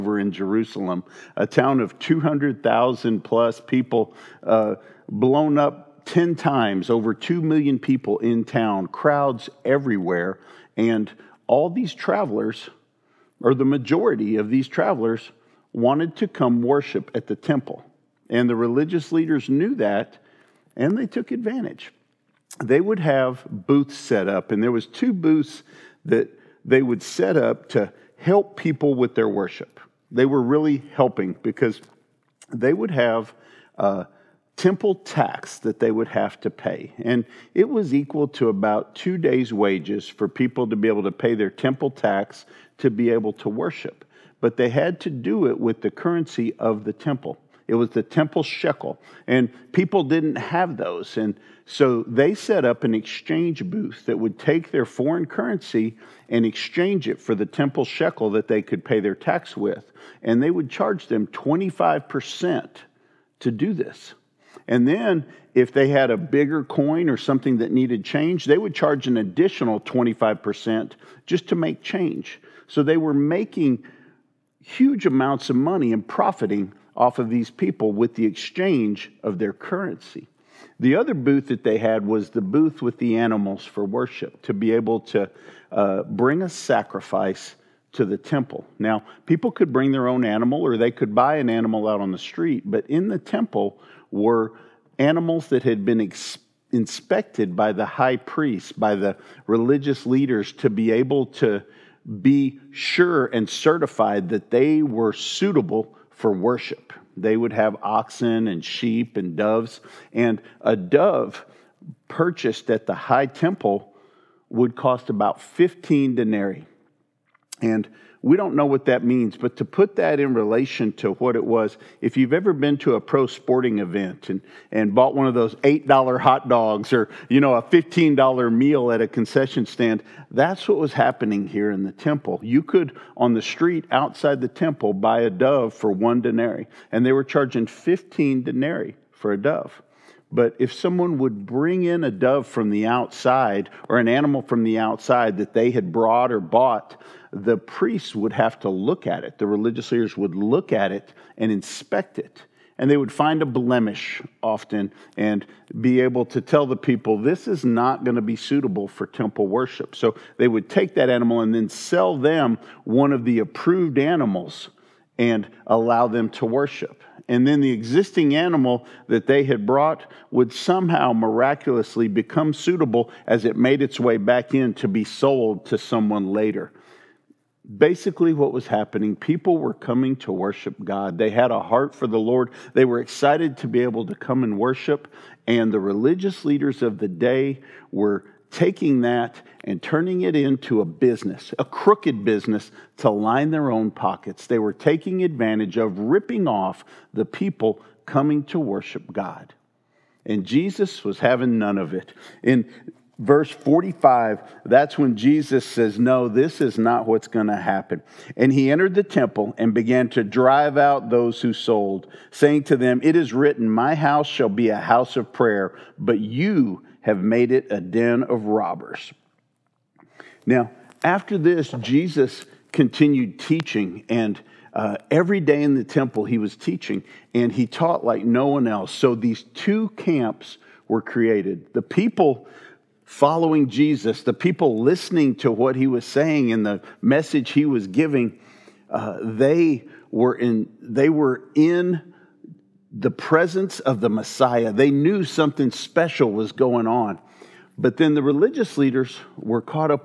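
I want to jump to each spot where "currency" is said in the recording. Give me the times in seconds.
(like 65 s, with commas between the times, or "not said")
45 s, 55 s, 79 s.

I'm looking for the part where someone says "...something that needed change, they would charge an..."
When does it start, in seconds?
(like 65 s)
67 s.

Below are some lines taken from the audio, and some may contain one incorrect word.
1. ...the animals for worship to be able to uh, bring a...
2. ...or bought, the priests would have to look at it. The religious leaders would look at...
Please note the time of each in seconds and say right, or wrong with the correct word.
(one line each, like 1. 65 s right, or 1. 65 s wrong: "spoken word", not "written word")
1. 82 s right
2. 146 s right.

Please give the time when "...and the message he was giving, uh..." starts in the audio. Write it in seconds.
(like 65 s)
236 s.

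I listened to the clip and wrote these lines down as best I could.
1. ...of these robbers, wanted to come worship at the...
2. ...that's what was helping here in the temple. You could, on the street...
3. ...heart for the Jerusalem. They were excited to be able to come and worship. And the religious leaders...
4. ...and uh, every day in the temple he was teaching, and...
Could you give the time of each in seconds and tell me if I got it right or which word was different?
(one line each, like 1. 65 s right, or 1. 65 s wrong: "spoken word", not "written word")
1. 14 s wrong: "travelers", not "robbers"
2. 130 s wrong: "happening", not "helping"
3. 181 s wrong: "Lord", not "Jerusalem"
4. 224 s right.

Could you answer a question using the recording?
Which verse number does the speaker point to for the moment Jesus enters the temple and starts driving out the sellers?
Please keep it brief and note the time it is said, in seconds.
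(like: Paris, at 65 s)
45, at 203 s.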